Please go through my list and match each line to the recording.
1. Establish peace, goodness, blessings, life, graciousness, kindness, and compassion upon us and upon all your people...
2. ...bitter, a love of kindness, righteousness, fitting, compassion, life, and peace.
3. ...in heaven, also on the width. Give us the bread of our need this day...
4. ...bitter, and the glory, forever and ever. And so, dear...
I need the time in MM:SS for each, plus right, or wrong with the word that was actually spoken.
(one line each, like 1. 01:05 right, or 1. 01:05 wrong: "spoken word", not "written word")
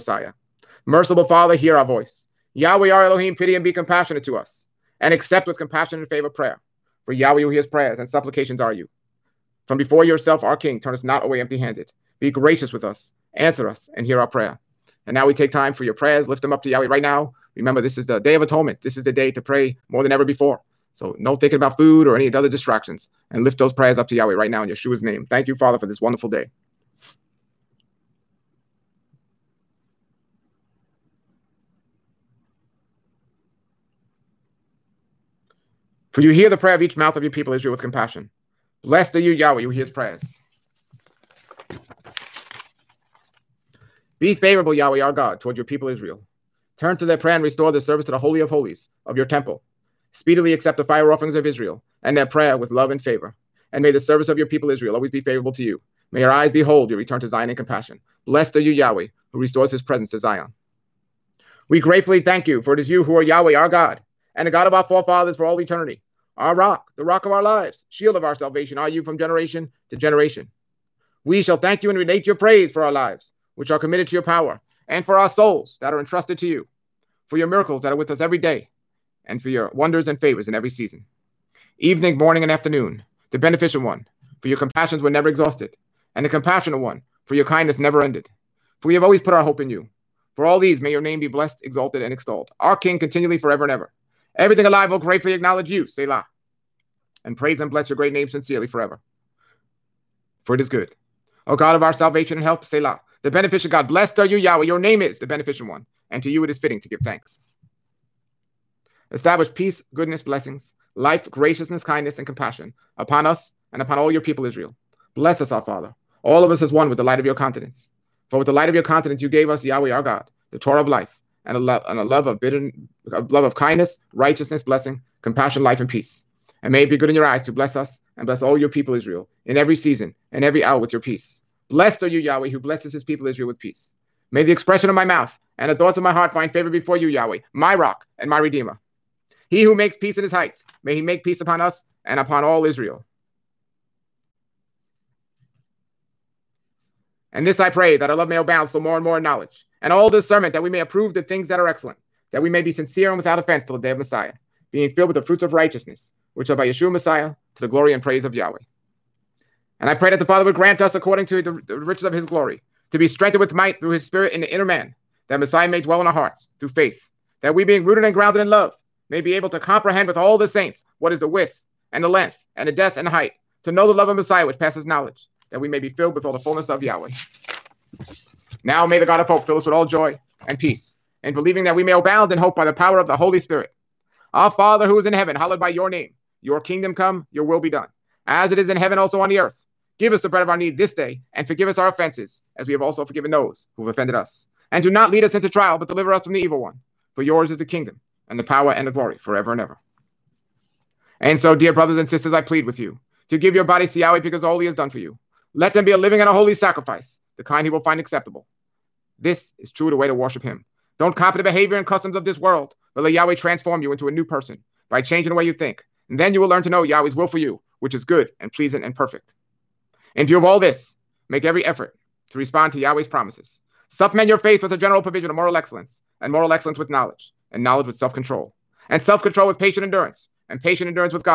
1. 01:49 right
2. 02:02 wrong: "blessing", not "fitting"
3. 03:08 wrong: "earth", not "width"
4. 03:18 wrong: "power", not "bitter".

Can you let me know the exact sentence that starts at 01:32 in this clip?
Our King continually, forever and ever.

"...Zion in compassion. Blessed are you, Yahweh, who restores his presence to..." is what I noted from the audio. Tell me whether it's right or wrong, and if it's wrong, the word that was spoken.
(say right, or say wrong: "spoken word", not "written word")
right.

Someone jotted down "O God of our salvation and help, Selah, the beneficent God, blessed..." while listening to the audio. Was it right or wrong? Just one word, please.
right.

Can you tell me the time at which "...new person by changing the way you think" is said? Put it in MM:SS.
03:34.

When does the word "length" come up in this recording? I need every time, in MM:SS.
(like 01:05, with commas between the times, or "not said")
02:52.